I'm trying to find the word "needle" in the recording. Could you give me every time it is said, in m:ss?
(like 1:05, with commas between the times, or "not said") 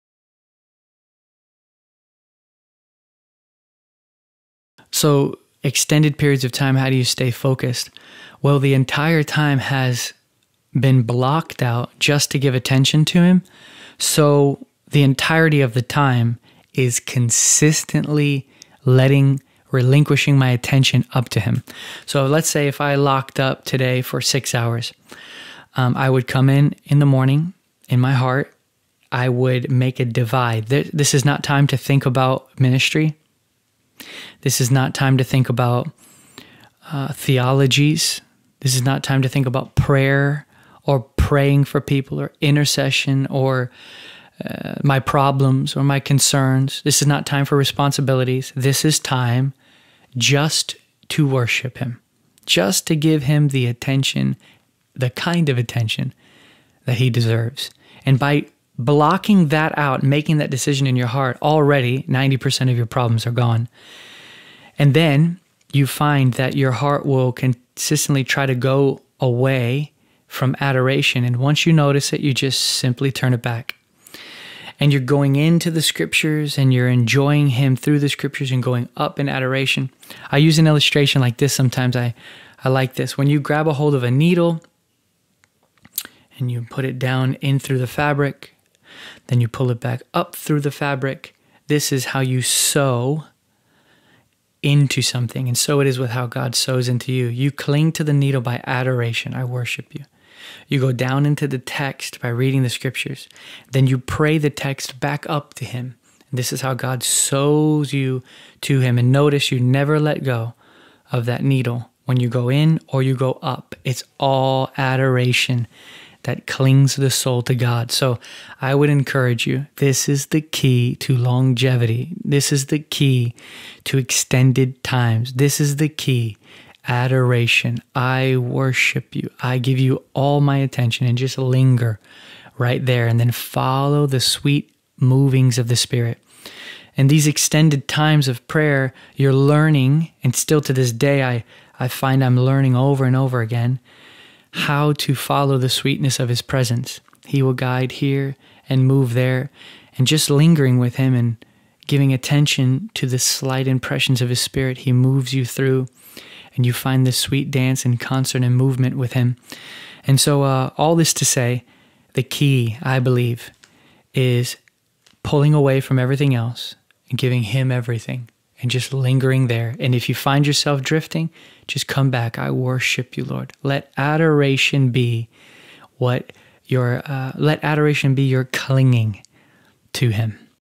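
1:24, 1:38, 1:51.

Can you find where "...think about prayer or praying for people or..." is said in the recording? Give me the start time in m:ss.
0:39.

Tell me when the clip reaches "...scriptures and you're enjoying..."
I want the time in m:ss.
1:15.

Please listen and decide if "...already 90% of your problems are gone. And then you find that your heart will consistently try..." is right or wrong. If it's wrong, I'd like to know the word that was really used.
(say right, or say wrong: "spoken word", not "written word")
right.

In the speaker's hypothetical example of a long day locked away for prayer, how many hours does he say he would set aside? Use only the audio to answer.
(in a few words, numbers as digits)
6.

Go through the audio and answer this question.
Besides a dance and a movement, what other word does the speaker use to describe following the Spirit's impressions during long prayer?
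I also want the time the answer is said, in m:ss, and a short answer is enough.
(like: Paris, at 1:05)
Concert, at 2:37.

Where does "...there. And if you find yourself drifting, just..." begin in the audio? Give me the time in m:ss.
2:49.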